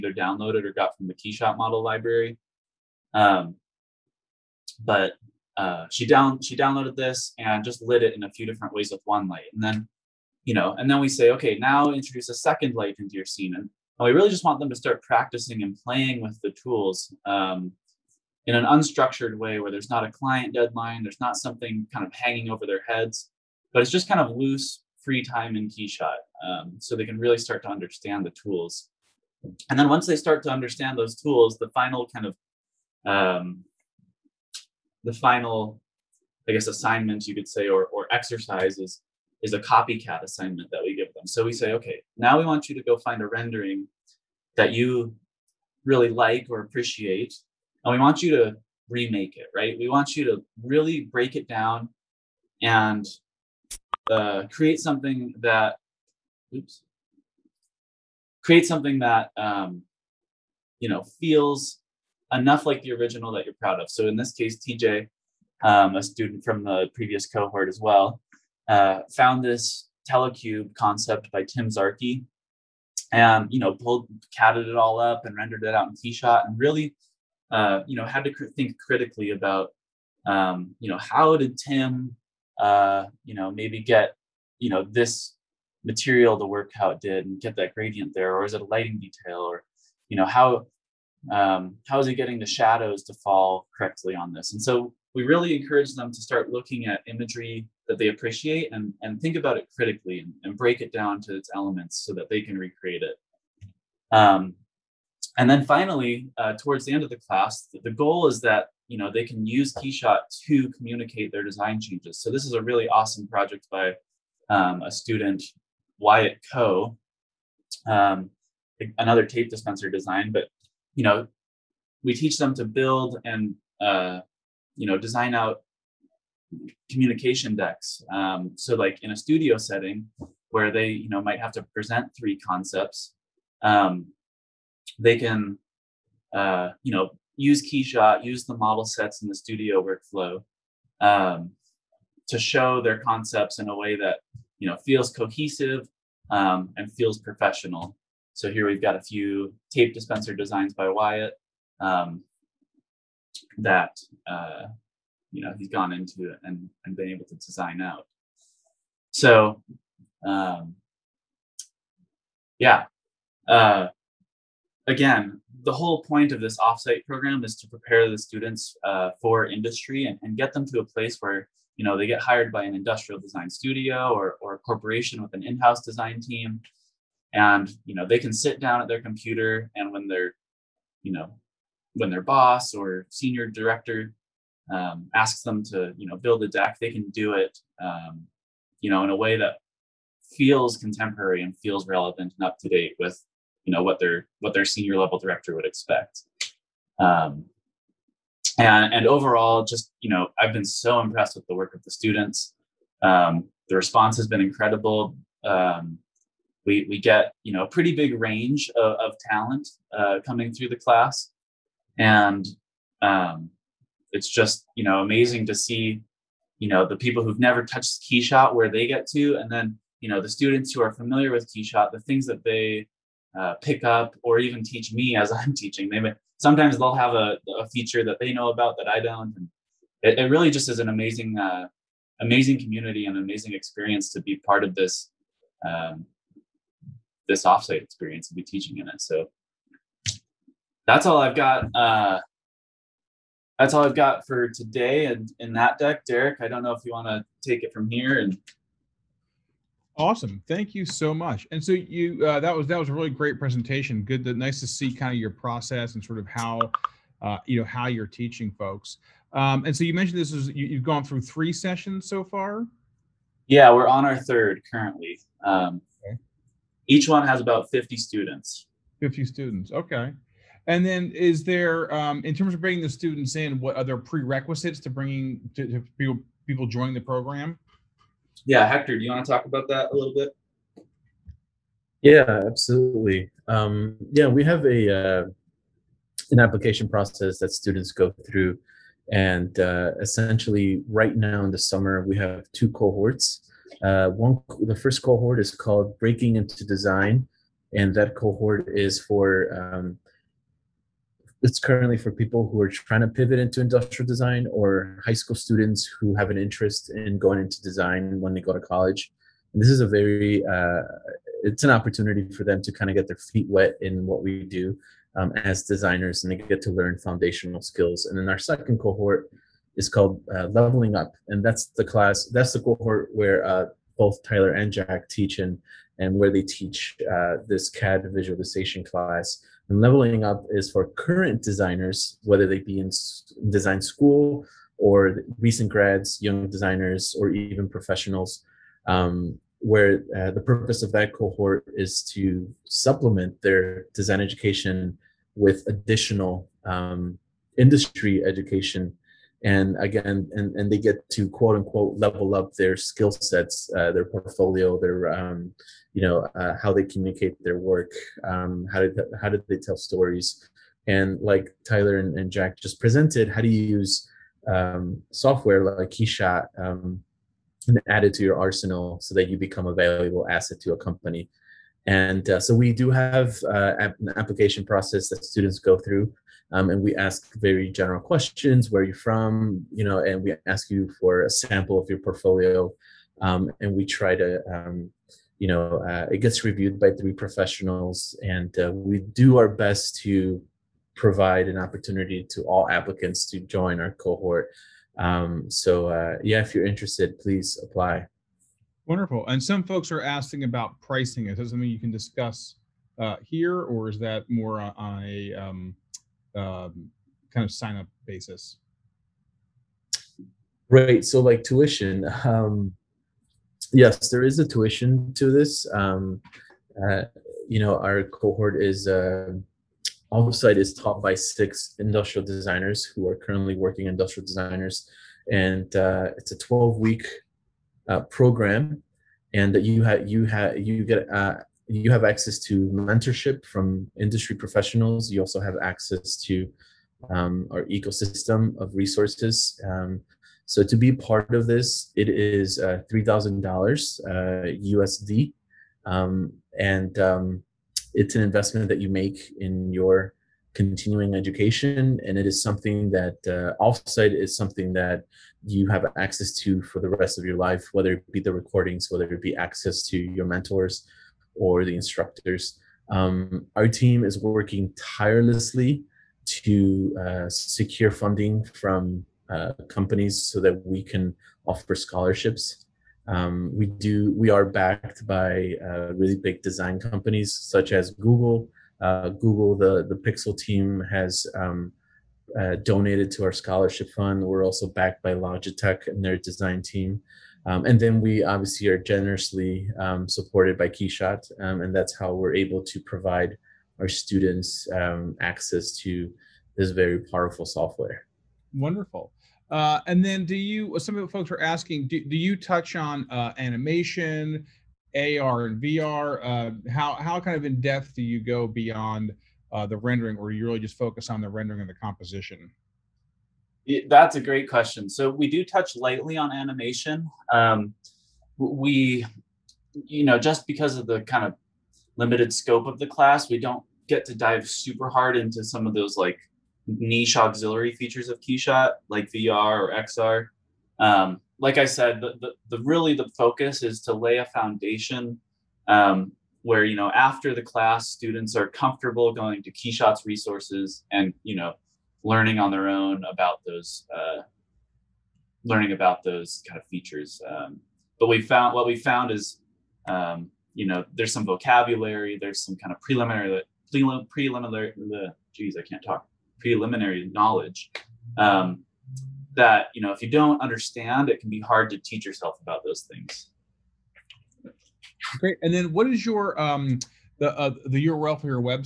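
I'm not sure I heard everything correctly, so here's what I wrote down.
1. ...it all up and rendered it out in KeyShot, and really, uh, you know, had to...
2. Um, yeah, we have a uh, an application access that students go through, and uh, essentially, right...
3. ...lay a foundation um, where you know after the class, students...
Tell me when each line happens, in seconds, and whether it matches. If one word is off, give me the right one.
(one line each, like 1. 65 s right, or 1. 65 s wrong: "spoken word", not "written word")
1. 74 s right
2. 283 s wrong: "process", not "access"
3. 533 s right.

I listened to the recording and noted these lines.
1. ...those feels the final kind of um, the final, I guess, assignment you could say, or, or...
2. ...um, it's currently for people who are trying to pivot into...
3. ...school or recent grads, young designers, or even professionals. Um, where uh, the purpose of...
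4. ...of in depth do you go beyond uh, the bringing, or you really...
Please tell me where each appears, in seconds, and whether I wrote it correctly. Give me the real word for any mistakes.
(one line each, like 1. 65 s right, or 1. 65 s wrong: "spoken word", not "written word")
1. 30 s wrong: "tools", not "feels"
2. 299 s right
3. 333 s right
4. 507 s wrong: "rendering", not "bringing".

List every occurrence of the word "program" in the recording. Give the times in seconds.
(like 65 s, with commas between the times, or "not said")
167 s, 277 s, 428 s.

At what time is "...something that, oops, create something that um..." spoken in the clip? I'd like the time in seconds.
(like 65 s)
54 s.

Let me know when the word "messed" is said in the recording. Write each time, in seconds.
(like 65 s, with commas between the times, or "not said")
not said.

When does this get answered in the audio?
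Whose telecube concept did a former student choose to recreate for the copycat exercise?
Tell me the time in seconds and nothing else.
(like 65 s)
71 s.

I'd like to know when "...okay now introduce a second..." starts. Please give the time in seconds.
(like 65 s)
11 s.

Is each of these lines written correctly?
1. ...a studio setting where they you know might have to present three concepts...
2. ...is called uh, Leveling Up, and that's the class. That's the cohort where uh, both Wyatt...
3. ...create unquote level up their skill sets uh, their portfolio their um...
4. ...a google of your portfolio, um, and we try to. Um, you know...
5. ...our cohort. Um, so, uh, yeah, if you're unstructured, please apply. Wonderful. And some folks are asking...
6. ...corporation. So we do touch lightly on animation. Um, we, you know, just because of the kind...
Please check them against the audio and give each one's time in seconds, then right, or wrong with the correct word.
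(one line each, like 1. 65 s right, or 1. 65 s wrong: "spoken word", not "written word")
1. 129 s right
2. 319 s wrong: "Tyler", not "Wyatt"
3. 351 s wrong: "quote", not "create"
4. 381 s wrong: "sample", not "google"
5. 393 s wrong: "interested", not "unstructured"
6. 514 s wrong: "question", not "corporation".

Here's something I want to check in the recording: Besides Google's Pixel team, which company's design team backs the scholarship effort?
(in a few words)
Logitech.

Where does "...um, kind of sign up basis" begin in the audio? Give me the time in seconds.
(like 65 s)
406 s.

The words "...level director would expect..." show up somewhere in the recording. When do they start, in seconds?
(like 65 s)
194 s.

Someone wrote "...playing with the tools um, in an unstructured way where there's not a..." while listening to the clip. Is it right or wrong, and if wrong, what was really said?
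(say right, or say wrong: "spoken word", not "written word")
right.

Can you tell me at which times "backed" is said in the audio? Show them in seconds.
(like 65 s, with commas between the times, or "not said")
474 s, 484 s.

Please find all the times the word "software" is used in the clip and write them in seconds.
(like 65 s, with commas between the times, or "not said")
365 s, 497 s.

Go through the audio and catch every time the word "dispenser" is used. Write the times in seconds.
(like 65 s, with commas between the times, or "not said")
119 s, 149 s.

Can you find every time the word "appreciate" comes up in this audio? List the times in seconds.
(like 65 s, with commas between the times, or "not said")
46 s, 98 s.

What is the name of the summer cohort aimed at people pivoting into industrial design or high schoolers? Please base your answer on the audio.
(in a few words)
Breaking into Design.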